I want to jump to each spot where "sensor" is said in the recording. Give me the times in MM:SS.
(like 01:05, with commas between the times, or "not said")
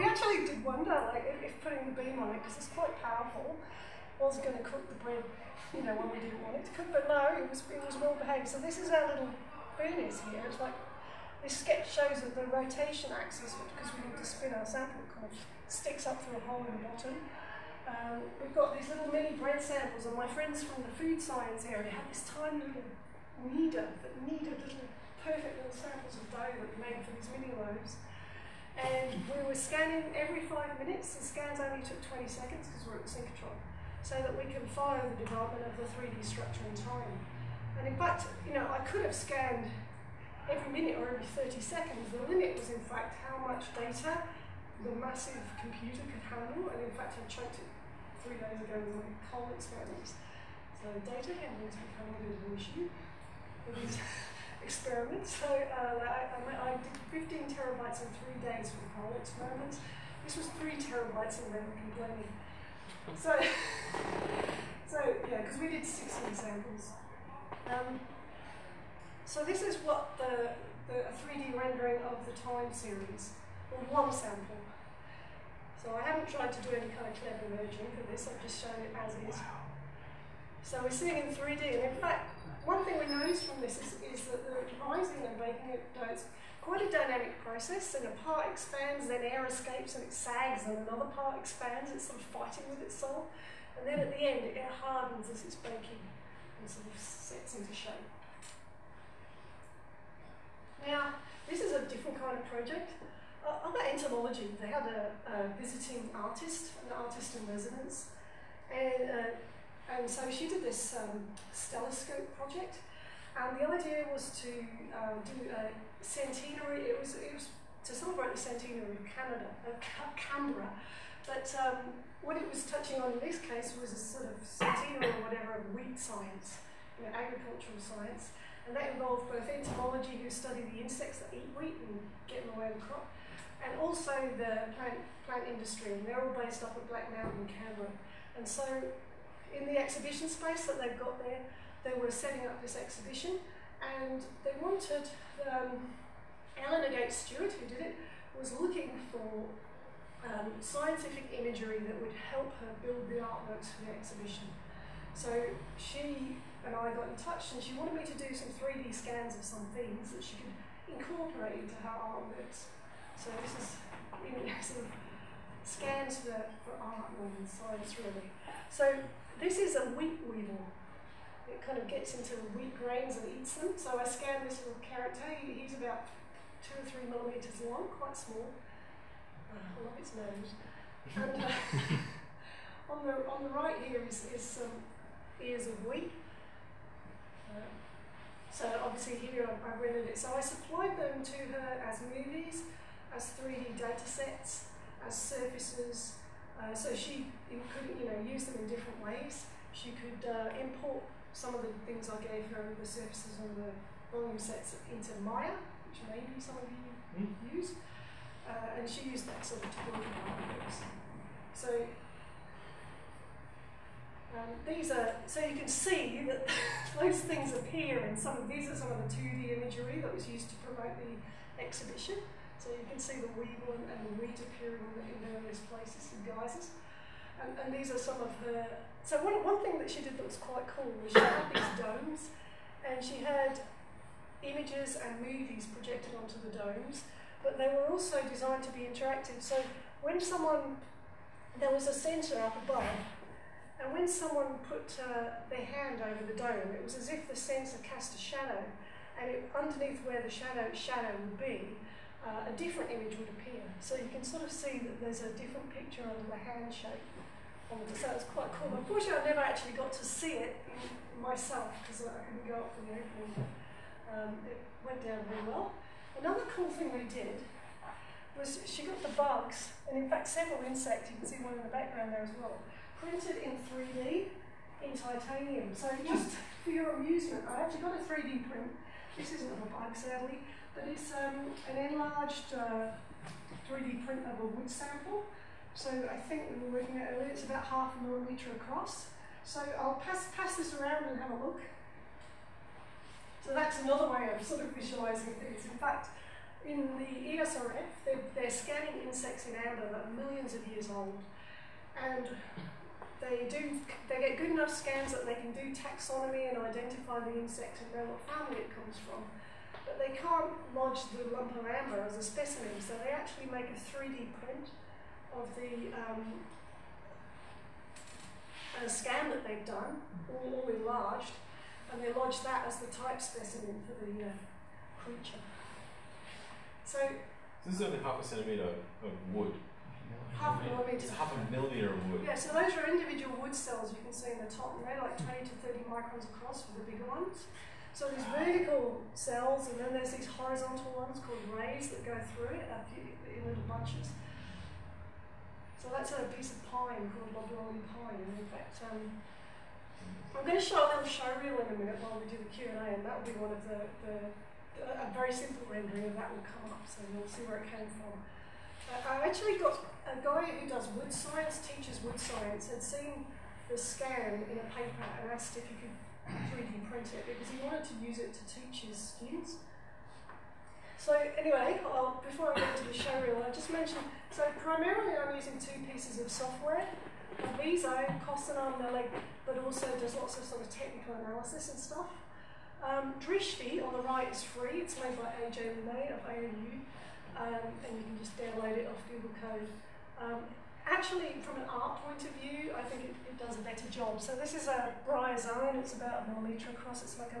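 04:01, 04:07.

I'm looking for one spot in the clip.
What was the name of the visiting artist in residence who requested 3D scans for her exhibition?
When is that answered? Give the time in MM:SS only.
02:26.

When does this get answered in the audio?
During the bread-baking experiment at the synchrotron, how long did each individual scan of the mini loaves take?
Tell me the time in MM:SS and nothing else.
00:32.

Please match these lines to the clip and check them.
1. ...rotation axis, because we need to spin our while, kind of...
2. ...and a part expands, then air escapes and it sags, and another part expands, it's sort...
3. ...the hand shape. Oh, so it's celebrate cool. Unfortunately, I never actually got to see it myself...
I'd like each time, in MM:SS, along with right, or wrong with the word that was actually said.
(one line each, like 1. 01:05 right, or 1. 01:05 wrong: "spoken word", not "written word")
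1. 00:12 wrong: "sample", not "while"
2. 01:27 right
3. 04:16 wrong: "quite", not "celebrate".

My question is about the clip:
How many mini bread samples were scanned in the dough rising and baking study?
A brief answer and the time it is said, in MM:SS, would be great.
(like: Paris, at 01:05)
16, at 01:05.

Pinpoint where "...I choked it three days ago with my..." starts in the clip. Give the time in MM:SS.
00:47.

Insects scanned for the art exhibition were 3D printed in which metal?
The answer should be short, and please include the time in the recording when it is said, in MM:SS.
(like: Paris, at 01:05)
Titanium, at 04:34.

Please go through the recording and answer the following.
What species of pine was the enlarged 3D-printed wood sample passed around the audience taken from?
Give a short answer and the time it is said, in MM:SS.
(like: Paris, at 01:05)
Loblolly pine, at 05:47.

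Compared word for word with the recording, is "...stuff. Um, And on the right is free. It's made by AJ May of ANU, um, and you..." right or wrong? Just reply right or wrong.
wrong.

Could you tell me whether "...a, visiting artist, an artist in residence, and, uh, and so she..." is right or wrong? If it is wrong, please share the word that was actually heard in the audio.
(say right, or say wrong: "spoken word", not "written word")
right.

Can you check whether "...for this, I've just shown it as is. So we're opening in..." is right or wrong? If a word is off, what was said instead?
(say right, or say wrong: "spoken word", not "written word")
wrong: "seeing", not "opening".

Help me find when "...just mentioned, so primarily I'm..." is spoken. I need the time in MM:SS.
06:13.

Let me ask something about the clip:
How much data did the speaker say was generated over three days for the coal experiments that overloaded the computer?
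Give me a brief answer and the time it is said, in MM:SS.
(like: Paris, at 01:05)
15 terabytes, at 00:57.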